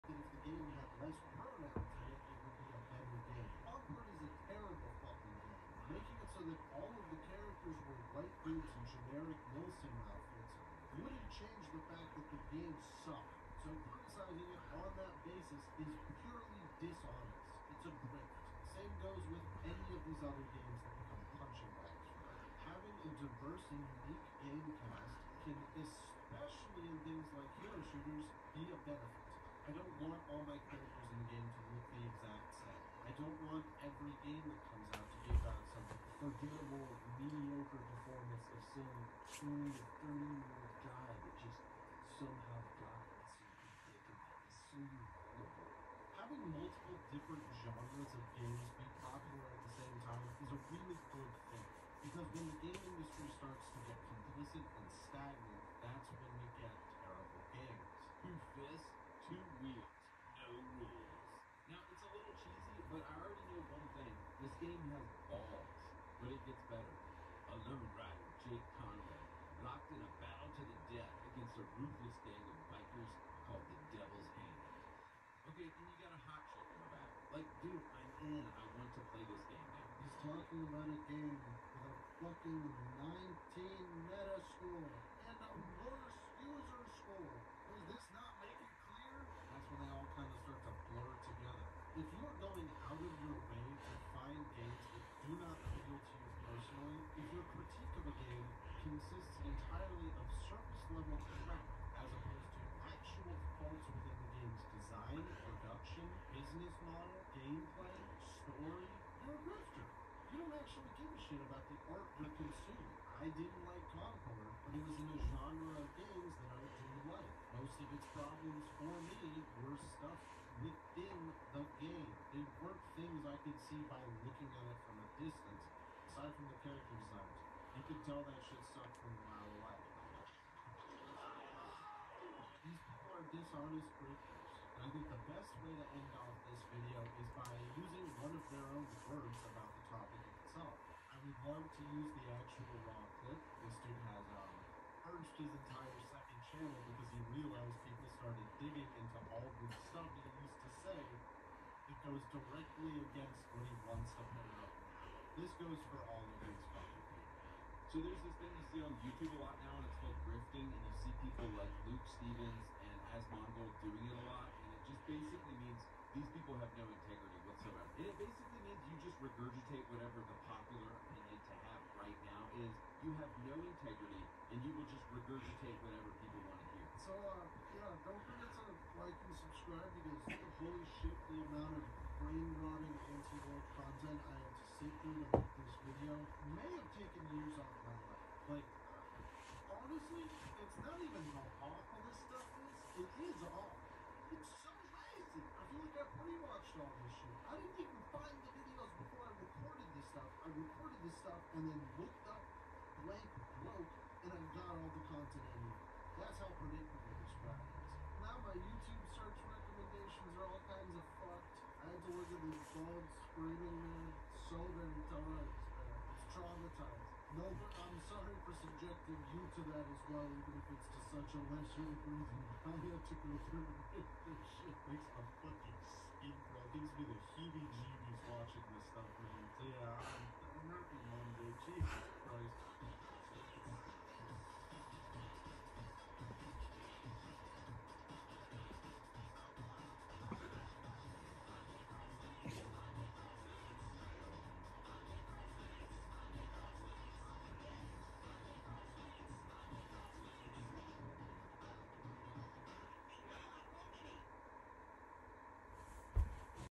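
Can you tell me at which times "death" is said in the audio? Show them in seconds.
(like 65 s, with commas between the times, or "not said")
70 s.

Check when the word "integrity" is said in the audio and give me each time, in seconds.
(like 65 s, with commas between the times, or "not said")
166 s, 173 s.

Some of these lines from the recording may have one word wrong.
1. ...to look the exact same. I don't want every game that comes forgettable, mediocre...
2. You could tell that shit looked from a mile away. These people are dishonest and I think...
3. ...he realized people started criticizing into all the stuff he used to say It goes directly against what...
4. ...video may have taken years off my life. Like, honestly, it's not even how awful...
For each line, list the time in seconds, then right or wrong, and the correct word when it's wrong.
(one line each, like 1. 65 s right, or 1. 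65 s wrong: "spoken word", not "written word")
1. 31 s right
2. 127 s wrong: "sucked", not "looked"
3. 147 s wrong: "digging", not "criticizing"
4. 185 s right.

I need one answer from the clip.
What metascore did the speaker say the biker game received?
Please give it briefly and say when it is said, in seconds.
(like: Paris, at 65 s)
19, at 83 s.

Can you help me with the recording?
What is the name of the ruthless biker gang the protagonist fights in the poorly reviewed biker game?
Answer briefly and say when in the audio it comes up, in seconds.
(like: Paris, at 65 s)
Devil's Hand, at 73 s.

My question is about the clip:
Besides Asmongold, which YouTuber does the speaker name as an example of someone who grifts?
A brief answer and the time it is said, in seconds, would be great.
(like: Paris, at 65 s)
Luke Stephens, at 161 s.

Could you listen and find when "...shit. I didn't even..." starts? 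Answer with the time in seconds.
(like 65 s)
197 s.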